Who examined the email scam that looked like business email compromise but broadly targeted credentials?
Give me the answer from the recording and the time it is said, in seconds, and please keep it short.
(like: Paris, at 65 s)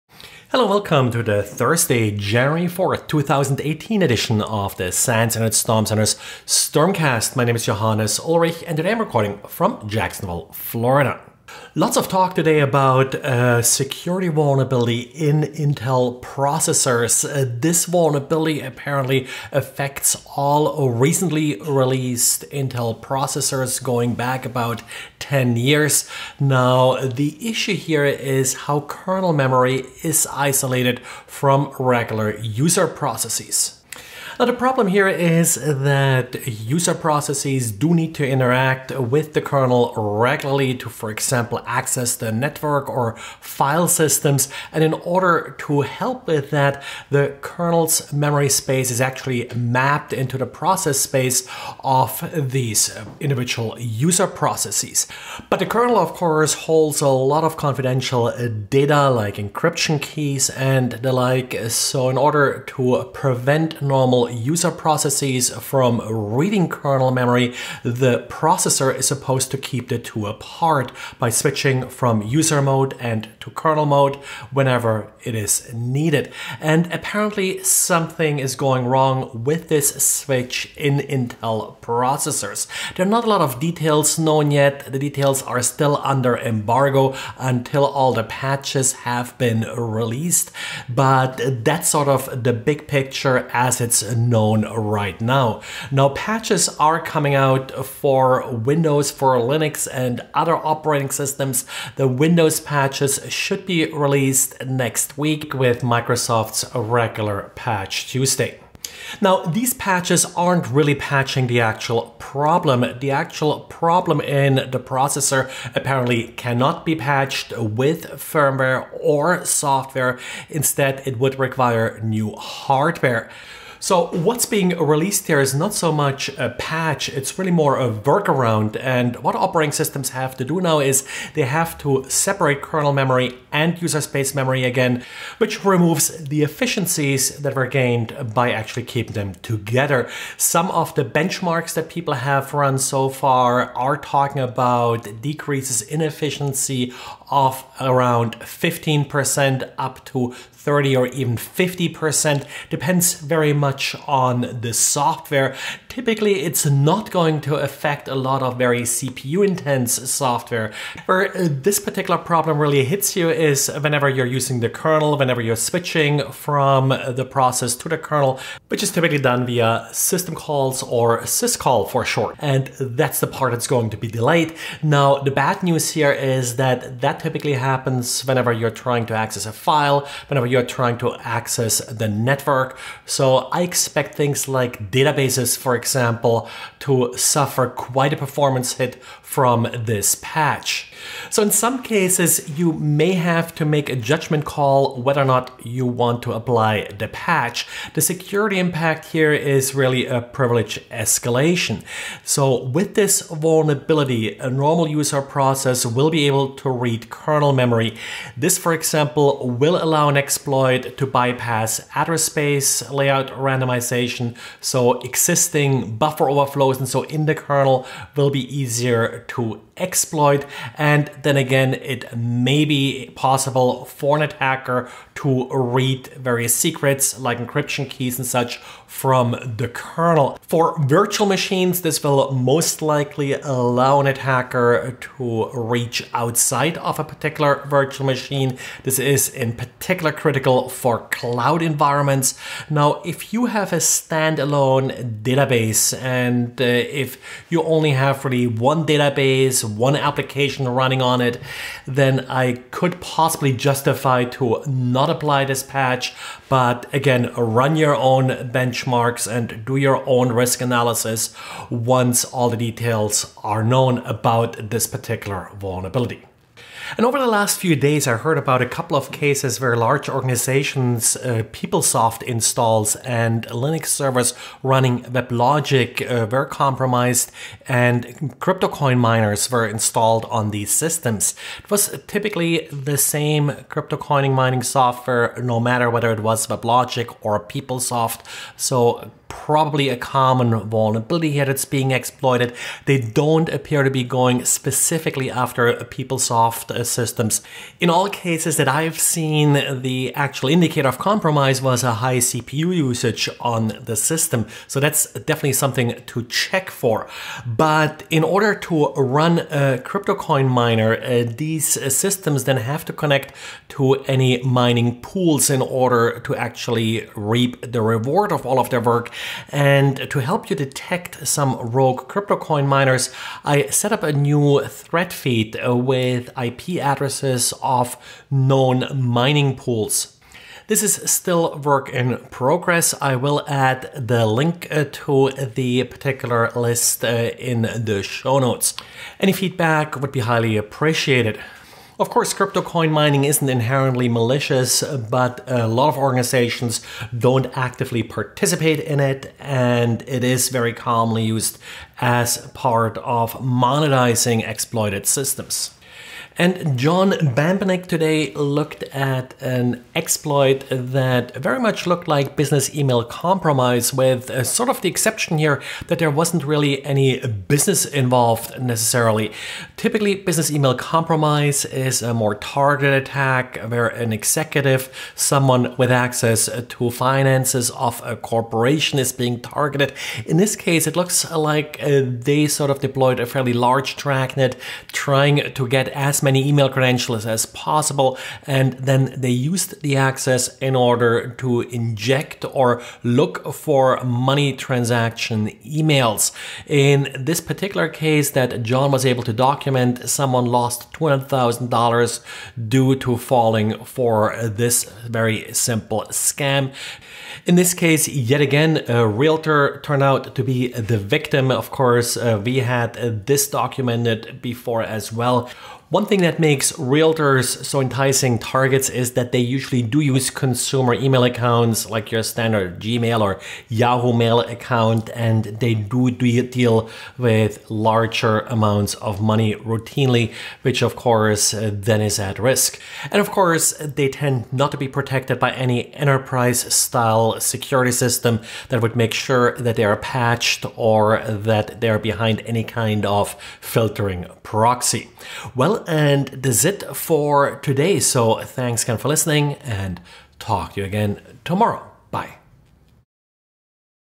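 John Bambenek, at 356 s.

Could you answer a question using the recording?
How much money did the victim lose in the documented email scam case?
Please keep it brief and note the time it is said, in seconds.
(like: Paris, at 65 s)
$200,000, at 400 s.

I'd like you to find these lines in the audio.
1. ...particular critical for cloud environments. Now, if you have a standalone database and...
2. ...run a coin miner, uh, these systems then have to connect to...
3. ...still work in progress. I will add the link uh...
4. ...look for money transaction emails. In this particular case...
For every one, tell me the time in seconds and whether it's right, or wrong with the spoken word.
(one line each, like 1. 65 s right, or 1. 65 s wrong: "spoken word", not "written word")
1. 239 s right
2. 308 s right
3. 331 s right
4. 393 s right.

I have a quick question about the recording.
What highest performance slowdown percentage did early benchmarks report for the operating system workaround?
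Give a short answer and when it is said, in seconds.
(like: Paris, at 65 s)
50%, at 151 s.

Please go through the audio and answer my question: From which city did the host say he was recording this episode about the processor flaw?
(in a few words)
Jacksonville, Florida.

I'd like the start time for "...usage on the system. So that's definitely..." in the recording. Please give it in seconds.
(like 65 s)
302 s.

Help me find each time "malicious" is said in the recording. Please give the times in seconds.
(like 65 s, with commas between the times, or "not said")
344 s.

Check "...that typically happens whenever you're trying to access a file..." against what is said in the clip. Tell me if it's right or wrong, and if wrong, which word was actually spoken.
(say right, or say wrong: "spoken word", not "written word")
right.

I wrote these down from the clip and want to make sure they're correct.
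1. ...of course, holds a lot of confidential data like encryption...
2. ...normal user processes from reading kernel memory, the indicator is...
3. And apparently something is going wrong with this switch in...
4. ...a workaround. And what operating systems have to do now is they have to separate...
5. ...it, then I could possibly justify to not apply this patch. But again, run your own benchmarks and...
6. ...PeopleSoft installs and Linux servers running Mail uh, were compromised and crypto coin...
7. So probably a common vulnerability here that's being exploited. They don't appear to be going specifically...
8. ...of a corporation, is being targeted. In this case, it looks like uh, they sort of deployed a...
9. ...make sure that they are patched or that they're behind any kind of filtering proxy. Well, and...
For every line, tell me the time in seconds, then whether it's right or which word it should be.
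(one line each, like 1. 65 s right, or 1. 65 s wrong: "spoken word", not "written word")
1. 55 s right
2. 63 s wrong: "processor", not "indicator"
3. 76 s right
4. 127 s right
5. 251 s right
6. 271 s wrong: "WebLogic", not "Mail"
7. 288 s right
8. 377 s right
9. 438 s right.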